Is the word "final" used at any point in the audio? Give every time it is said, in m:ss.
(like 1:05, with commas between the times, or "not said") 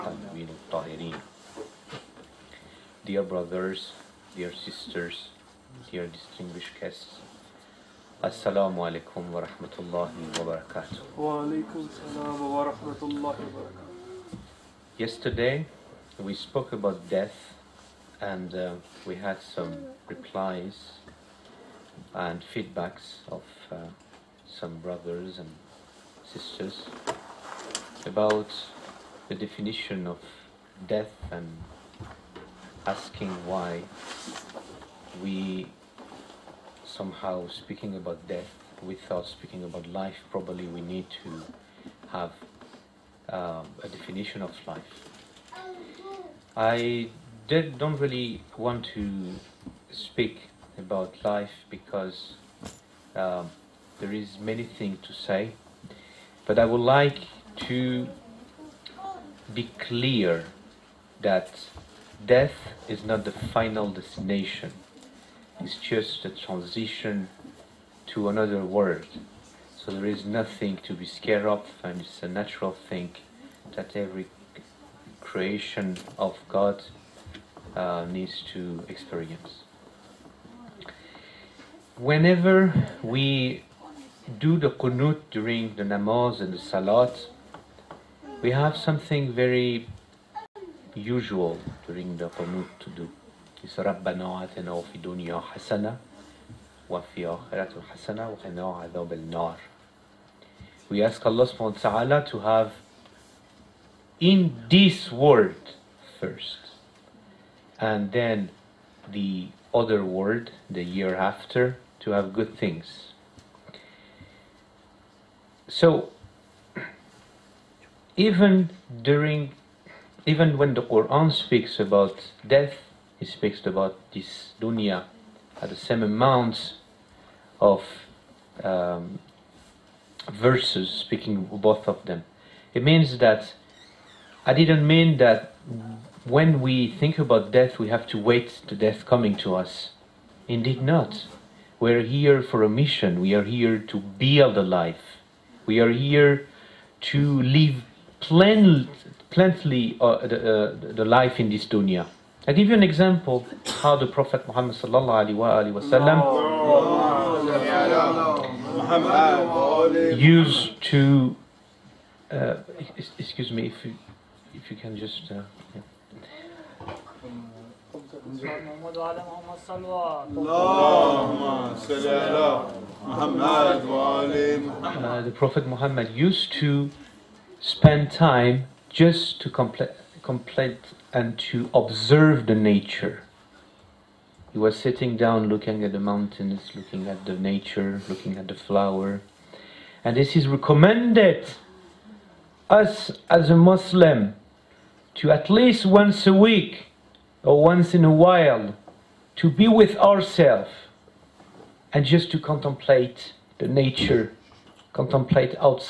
1:03.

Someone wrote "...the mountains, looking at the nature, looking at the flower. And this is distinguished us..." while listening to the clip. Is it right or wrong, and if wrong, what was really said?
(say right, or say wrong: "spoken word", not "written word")
wrong: "recommended", not "distinguished".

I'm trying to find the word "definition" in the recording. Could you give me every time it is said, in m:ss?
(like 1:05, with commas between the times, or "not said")
0:29, 0:43.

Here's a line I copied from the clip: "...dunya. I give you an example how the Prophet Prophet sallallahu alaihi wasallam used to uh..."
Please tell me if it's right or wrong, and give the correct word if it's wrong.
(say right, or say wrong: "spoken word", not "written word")
wrong: "Muhammad", not "Prophet".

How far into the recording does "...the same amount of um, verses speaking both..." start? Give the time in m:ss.
2:05.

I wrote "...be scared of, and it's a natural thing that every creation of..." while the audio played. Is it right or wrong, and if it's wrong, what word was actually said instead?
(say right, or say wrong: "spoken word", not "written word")
right.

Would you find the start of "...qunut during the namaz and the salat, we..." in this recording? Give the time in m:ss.
1:24.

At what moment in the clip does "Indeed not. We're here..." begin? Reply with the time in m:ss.
2:20.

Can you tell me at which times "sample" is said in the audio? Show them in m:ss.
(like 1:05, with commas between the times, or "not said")
not said.